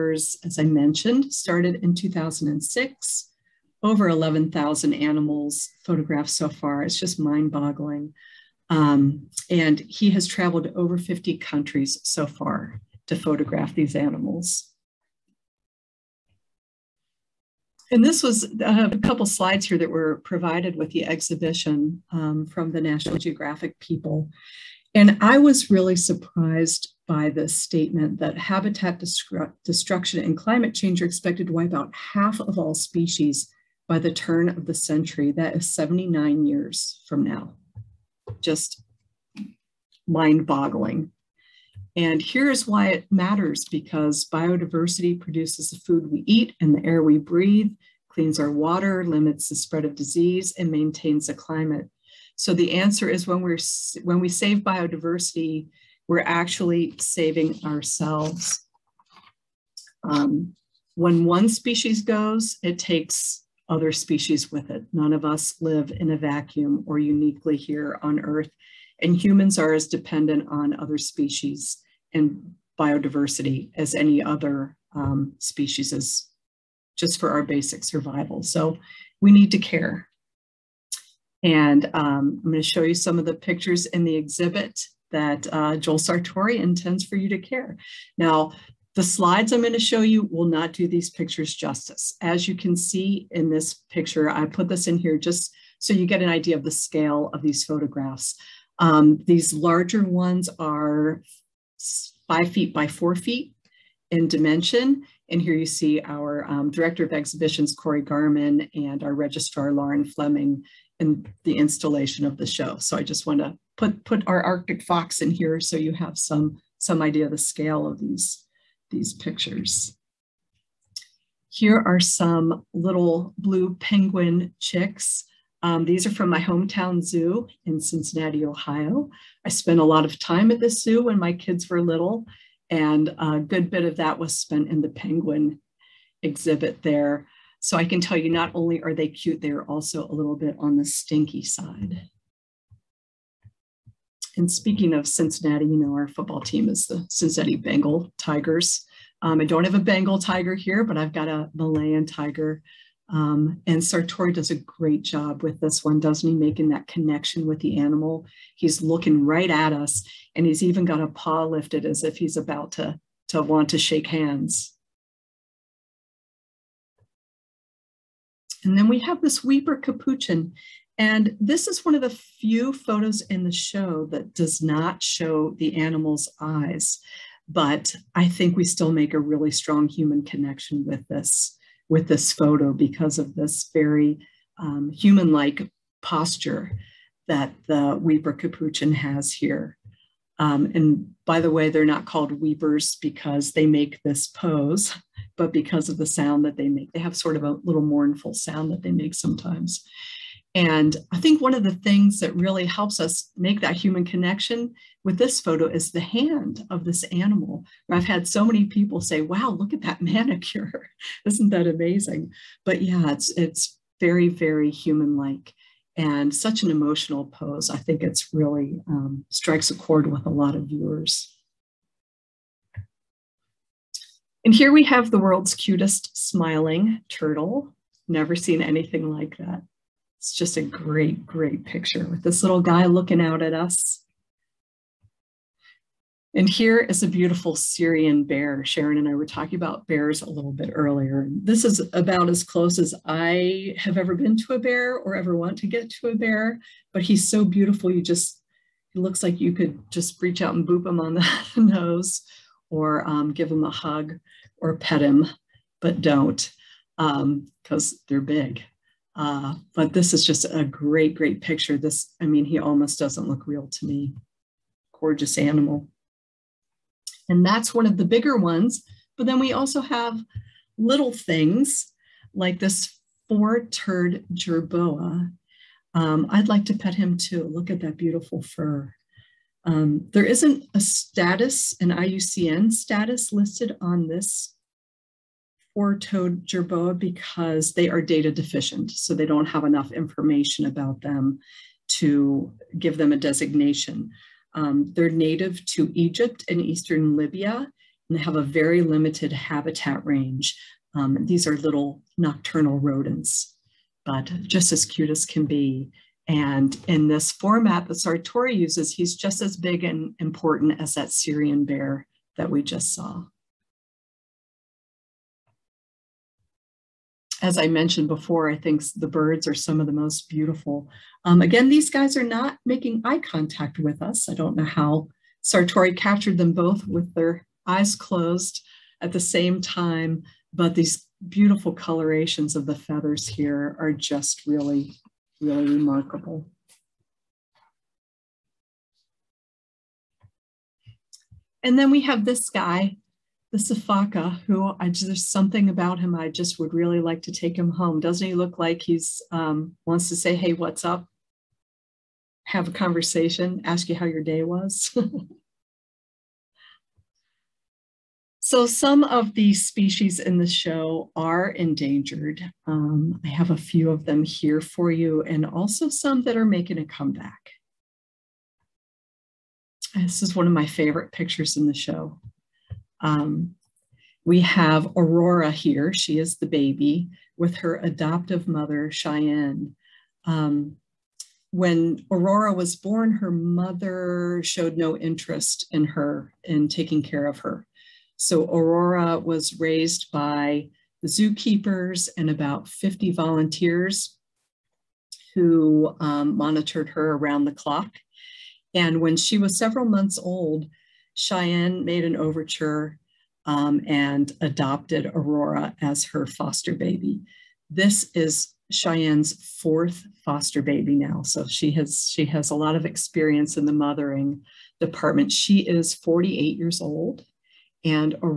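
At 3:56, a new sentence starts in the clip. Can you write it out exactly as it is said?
And here is a beautiful Syrian bear.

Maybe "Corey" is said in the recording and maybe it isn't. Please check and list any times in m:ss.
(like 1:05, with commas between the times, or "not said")
1:47.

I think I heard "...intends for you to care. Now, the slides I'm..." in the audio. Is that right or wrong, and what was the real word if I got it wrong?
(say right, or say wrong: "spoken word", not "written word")
right.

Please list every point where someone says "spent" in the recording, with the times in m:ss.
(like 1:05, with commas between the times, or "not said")
2:09, 2:14.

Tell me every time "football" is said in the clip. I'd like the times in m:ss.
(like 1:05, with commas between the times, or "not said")
2:26.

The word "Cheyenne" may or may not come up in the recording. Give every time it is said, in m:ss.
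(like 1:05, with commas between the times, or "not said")
6:18, 6:41, 6:48.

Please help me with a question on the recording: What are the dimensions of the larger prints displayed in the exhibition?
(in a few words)
5 feet by 4 feet.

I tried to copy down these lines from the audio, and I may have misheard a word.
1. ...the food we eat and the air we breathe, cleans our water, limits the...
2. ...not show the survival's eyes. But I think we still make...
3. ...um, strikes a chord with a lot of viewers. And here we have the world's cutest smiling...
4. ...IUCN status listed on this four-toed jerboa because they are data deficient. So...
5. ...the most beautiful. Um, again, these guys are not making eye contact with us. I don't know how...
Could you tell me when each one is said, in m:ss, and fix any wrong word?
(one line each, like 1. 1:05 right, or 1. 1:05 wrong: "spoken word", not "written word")
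1. 0:45 right
2. 2:54 wrong: "animal", not "survival"
3. 3:38 right
4. 4:41 right
5. 5:19 right.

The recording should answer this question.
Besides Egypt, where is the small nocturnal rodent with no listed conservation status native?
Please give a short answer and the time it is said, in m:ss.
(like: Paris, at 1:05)
Eastern Libya, at 4:56.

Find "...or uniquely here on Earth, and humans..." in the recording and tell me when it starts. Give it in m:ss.
1:06.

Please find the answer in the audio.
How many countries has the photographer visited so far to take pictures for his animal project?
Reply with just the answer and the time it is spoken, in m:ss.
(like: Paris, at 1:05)
Over 50, at 0:10.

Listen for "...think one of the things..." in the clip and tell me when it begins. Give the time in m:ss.
3:21.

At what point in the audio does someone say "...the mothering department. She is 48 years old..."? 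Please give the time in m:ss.
6:53.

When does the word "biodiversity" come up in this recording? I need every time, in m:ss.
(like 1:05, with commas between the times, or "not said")
0:44, 0:54, 1:12.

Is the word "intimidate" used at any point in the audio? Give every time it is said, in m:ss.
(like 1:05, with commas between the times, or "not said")
not said.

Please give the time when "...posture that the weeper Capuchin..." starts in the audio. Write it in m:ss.
3:06.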